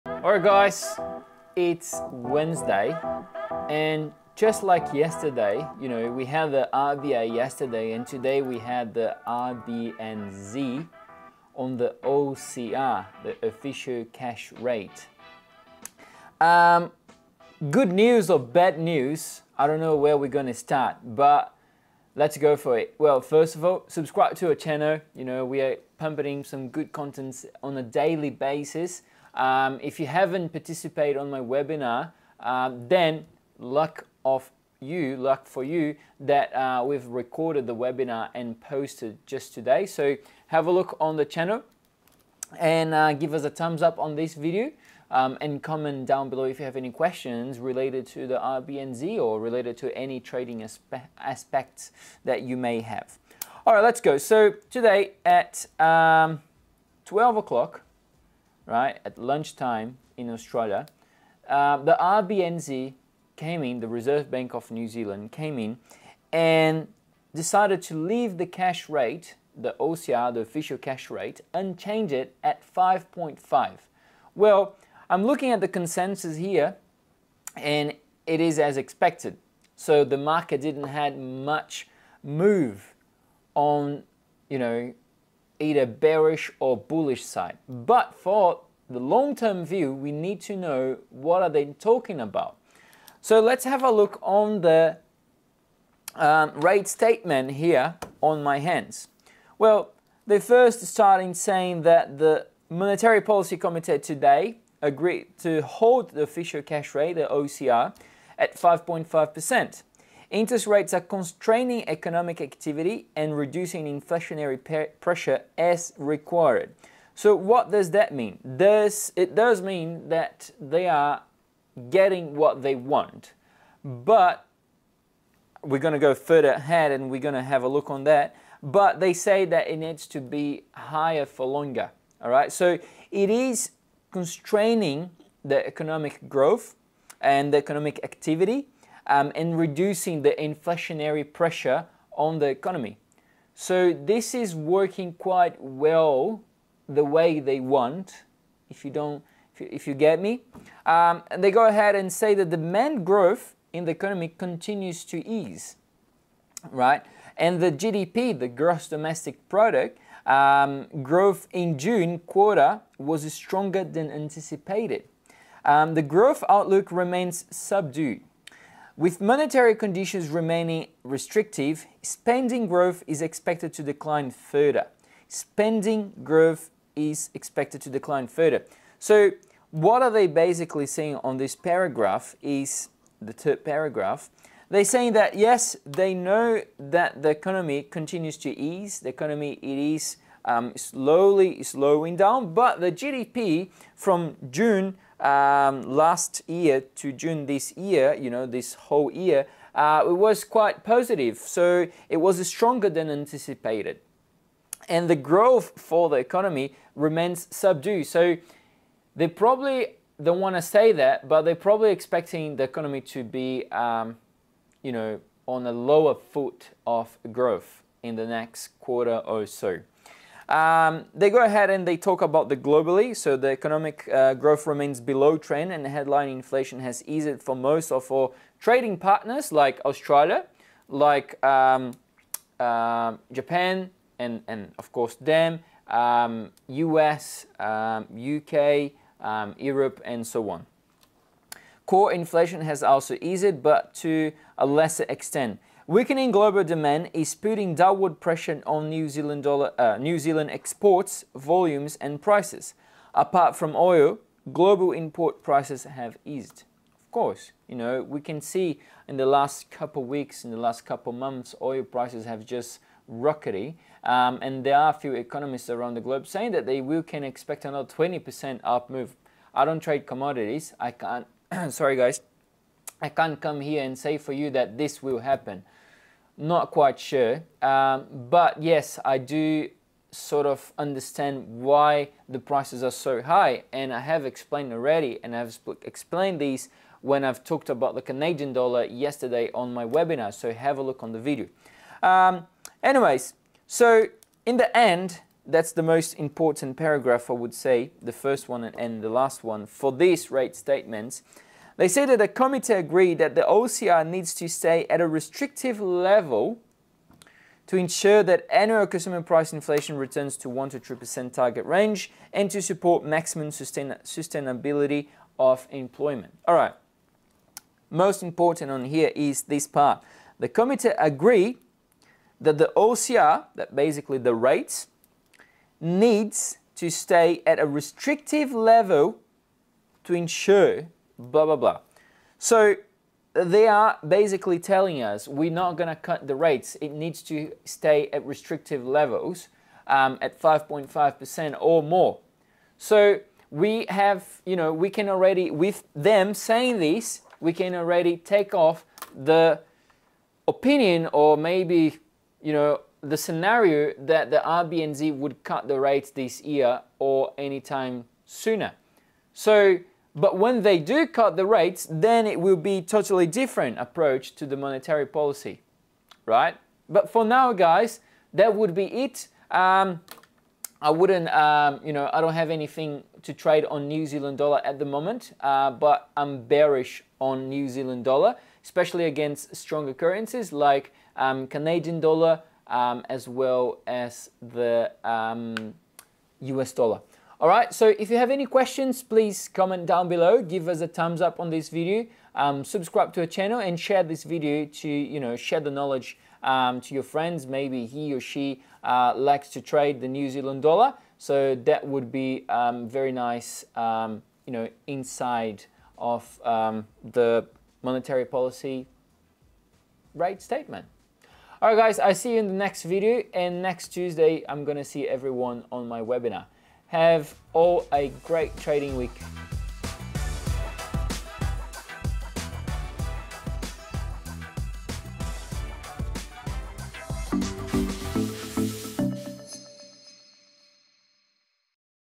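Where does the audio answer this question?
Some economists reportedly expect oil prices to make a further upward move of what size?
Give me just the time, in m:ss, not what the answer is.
4:27.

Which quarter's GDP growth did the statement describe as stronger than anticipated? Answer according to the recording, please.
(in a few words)
June quarter.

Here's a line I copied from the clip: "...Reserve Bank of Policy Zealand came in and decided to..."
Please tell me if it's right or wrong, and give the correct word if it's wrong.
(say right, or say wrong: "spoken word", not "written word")
wrong: "New", not "Policy".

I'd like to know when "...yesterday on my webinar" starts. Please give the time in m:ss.
4:48.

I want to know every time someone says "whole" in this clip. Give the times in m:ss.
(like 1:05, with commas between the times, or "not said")
3:18.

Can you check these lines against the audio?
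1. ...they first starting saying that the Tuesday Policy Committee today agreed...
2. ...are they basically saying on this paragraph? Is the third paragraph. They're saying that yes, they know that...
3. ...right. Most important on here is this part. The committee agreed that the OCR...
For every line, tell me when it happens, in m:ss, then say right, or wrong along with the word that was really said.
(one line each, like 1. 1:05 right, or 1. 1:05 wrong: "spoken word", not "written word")
1. 1:40 wrong: "Monetary", not "Tuesday"
2. 3:00 right
3. 5:16 right.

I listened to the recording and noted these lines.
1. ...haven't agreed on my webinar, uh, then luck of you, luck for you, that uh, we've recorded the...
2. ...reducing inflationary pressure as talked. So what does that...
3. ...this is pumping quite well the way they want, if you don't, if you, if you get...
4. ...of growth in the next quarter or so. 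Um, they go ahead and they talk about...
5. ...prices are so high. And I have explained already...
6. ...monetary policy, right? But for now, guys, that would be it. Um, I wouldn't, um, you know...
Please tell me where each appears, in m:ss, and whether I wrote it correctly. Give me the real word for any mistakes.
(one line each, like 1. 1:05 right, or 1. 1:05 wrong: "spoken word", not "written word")
1. 0:30 wrong: "participated", not "agreed"
2. 1:53 wrong: "required", not "talked"
3. 2:23 wrong: "working", not "pumping"
4. 3:36 right
5. 4:42 right
6. 6:04 right.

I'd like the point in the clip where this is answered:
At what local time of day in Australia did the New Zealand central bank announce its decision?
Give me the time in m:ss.
0:57.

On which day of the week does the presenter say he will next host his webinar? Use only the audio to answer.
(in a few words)
Tuesday.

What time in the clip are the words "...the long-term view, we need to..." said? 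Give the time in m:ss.
1:28.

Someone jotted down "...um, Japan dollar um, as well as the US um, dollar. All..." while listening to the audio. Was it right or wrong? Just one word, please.
wrong.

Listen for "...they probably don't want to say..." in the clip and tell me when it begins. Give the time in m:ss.
3:29.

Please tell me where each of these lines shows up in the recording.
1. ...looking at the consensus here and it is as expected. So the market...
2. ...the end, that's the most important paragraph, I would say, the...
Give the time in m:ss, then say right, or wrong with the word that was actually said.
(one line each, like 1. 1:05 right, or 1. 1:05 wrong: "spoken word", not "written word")
1. 1:15 right
2. 4:54 right.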